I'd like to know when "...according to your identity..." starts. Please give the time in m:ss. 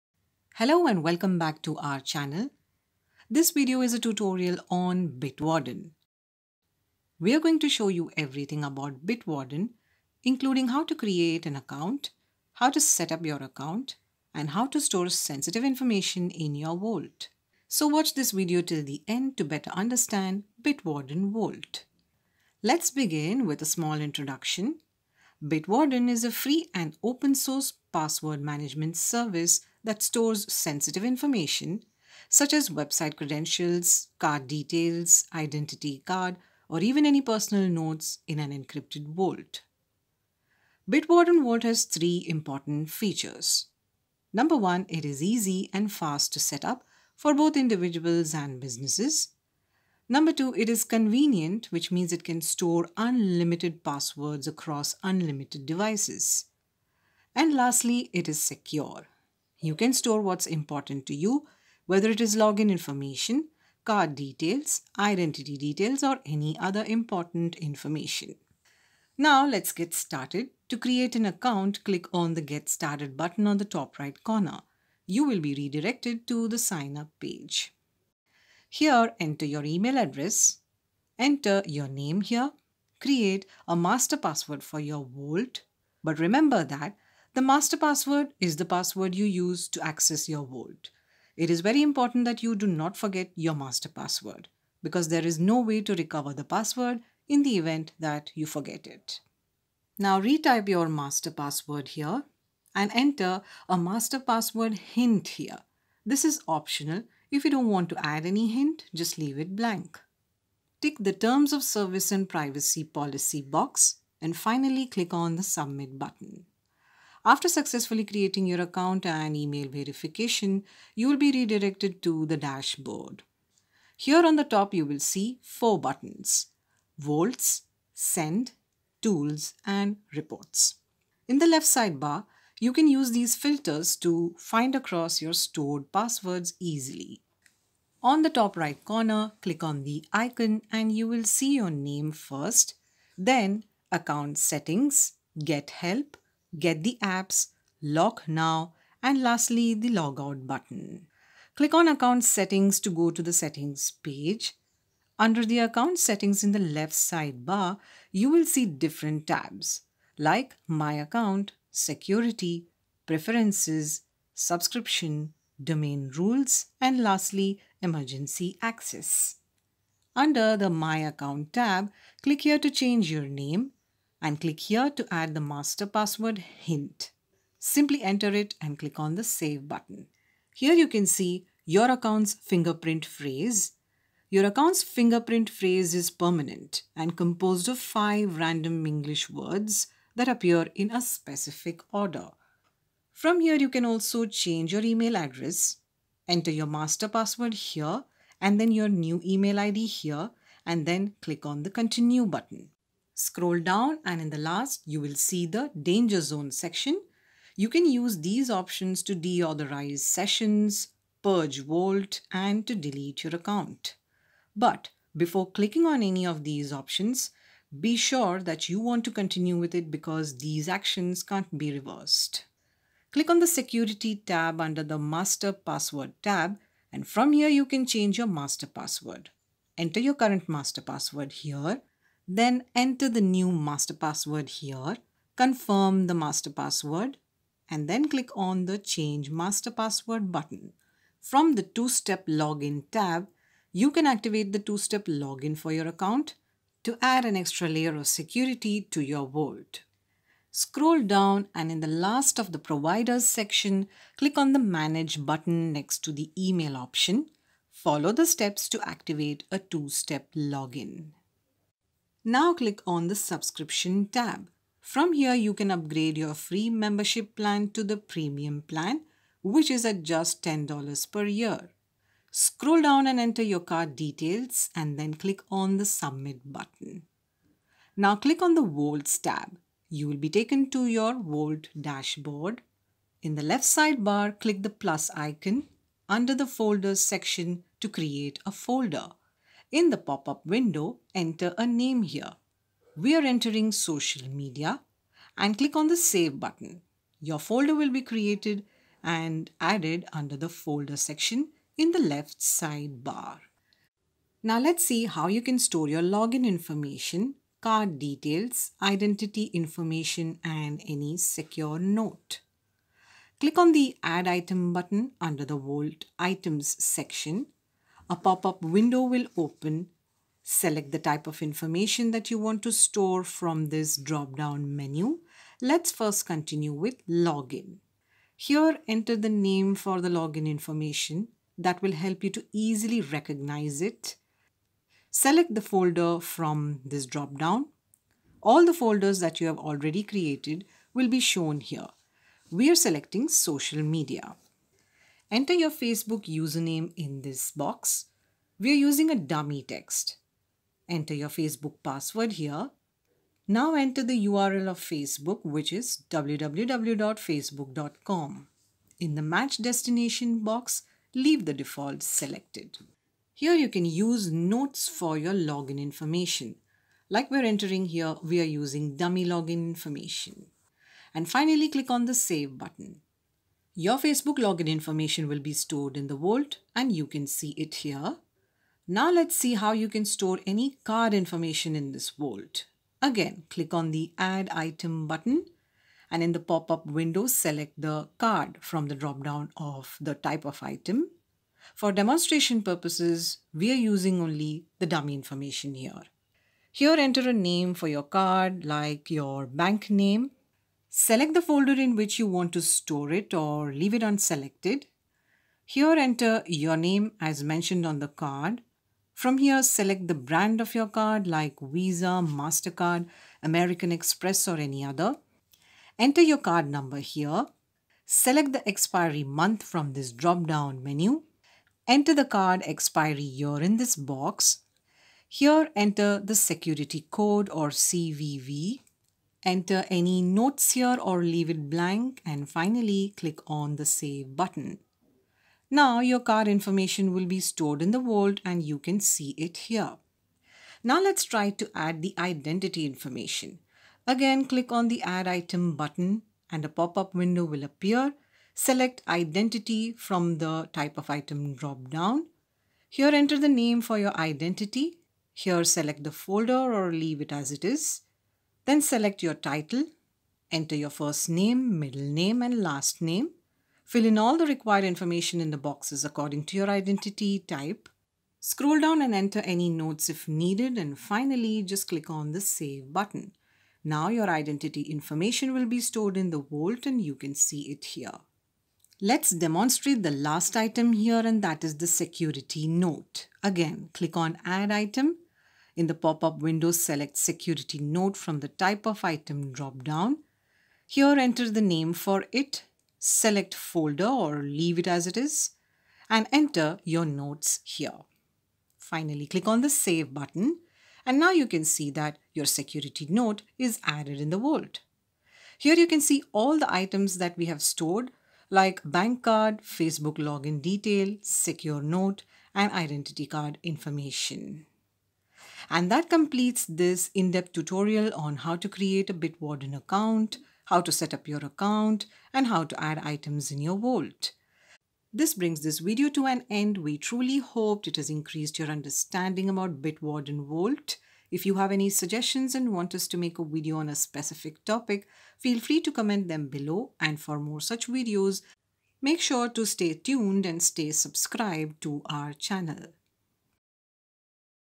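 7:46.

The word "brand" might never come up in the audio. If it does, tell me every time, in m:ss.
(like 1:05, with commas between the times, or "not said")
6:50.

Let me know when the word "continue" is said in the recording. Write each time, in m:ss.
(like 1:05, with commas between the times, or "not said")
3:21, 3:39, 5:26.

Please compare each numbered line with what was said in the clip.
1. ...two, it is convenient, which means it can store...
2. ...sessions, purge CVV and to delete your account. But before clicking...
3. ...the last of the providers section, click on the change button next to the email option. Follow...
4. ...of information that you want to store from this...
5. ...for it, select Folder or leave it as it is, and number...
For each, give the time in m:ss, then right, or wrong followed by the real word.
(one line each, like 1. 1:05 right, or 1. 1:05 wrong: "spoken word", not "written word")
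1. 0:50 right
2. 3:29 wrong: "Vault", not "CVV"
3. 4:11 wrong: "manage", not "change"
4. 5:21 right
5. 8:11 wrong: "enter", not "number".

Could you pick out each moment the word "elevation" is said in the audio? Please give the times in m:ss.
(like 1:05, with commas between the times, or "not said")
not said.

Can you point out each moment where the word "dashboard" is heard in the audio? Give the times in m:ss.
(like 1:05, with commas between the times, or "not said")
2:02, 4:41.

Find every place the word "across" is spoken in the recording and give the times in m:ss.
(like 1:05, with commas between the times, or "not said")
0:54, 2:14.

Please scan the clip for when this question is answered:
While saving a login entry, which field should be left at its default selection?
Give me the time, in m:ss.
5:59.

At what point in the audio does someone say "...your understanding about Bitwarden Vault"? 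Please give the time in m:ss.
8:48.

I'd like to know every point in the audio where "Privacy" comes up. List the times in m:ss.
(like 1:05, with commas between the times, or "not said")
1:52.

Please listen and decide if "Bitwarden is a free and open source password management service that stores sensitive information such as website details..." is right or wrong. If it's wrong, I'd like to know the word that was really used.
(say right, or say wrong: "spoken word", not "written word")
wrong: "credentials", not "details".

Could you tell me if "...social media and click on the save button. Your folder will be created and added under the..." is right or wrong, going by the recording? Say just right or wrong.
right.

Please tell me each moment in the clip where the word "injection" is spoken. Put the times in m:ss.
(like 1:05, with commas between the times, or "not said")
not said.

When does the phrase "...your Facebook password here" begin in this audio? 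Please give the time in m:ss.
5:51.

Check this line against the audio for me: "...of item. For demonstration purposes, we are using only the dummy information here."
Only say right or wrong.
right.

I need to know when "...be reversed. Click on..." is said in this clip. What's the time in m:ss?
3:41.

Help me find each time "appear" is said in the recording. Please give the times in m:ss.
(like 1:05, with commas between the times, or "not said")
3:10, 7:27.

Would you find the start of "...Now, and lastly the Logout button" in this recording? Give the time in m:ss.
2:28.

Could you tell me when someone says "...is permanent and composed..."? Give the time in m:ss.
3:05.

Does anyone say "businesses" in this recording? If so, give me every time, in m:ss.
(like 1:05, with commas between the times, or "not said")
0:48.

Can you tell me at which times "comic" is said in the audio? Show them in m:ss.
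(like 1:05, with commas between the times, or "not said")
not said.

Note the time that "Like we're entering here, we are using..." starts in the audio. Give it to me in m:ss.
6:07.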